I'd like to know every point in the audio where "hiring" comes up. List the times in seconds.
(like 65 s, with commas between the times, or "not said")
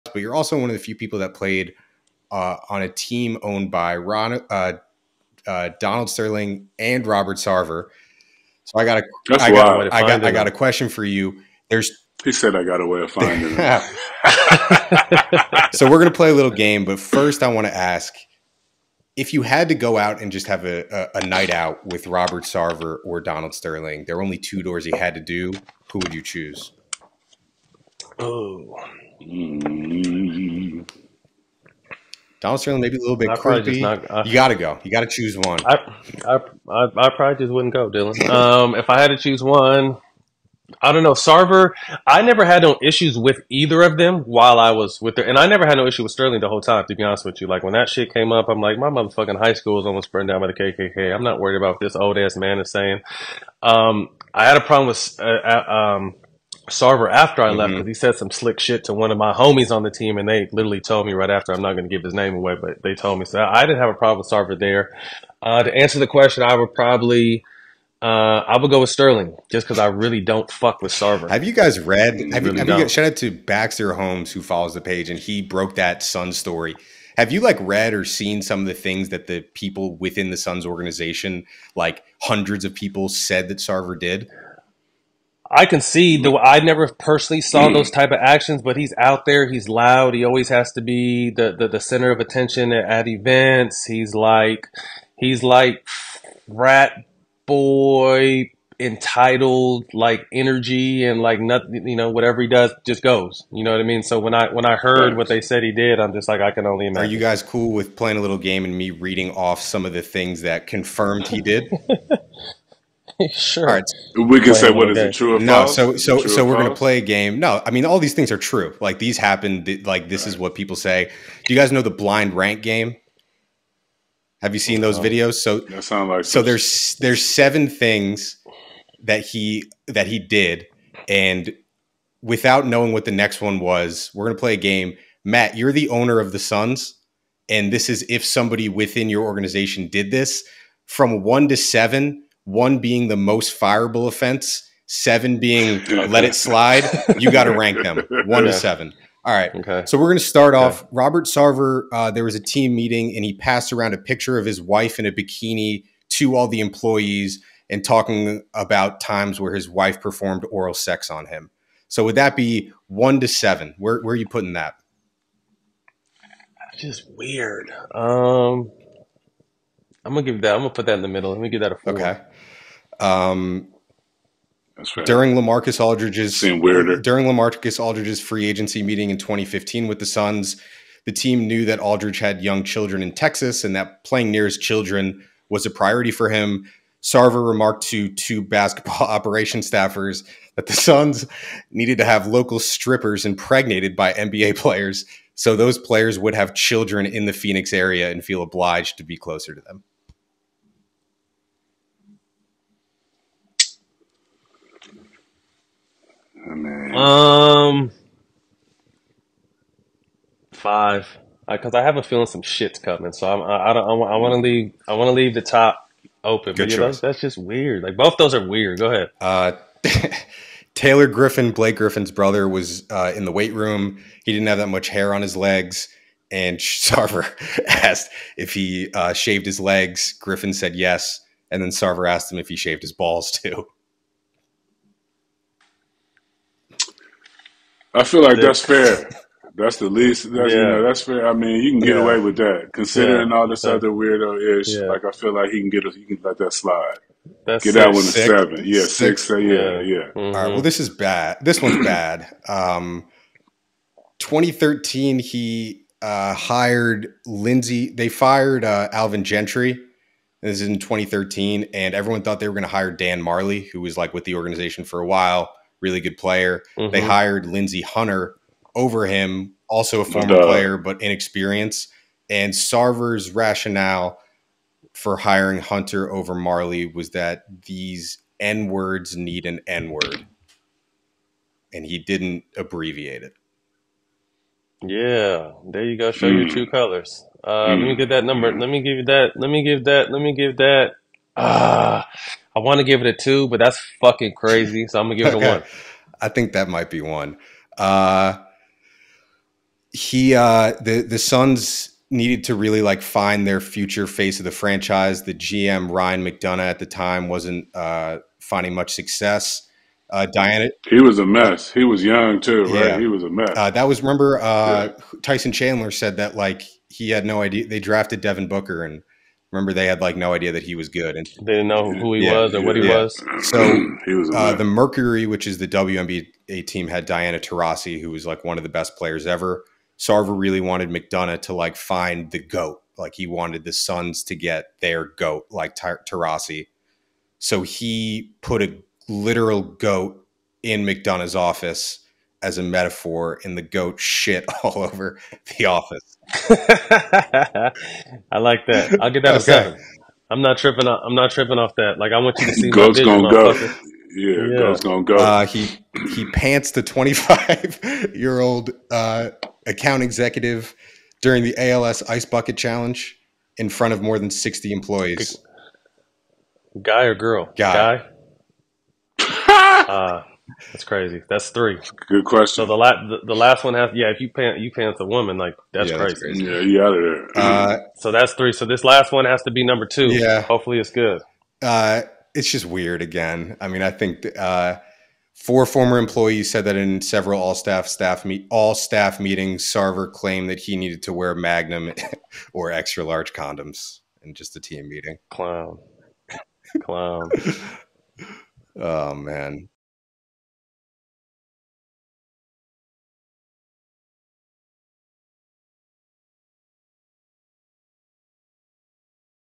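275 s.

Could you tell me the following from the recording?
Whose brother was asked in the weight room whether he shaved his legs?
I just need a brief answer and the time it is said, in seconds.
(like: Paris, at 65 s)
Blake Griffin, at 221 s.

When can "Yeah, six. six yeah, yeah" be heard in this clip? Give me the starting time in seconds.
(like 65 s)
248 s.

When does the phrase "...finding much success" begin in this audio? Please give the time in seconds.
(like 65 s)
308 s.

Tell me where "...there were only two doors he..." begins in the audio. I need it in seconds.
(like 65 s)
24 s.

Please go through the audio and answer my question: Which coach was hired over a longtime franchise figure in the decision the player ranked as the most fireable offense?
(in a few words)
Lindsey Hunter.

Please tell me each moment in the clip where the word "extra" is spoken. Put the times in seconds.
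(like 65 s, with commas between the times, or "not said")
392 s.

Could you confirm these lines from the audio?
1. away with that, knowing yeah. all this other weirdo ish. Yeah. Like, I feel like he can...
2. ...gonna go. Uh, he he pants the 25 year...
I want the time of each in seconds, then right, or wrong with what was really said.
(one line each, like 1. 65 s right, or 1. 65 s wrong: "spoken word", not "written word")
1. 242 s wrong: "considering", not "knowing"
2. 354 s right.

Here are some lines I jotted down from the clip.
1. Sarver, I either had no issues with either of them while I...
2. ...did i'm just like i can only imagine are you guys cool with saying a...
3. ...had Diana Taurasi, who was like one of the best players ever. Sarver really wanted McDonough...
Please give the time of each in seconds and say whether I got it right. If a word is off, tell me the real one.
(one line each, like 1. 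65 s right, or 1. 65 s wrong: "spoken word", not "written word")
1. 41 s wrong: "never", not "either"
2. 105 s wrong: "playing", not "saying"
3. 326 s right.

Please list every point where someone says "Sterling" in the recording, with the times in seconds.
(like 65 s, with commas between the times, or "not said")
6 s, 23 s, 32 s, 46 s, 68 s.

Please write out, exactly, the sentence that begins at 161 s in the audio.
So would that be one to seven?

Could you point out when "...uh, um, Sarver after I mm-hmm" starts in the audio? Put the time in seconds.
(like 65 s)
55 s.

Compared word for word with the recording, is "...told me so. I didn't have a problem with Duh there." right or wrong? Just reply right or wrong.
wrong.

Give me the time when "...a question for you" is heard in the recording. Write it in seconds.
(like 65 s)
10 s.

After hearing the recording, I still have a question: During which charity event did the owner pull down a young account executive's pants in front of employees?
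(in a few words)
ALS Ice Bucket Challenge.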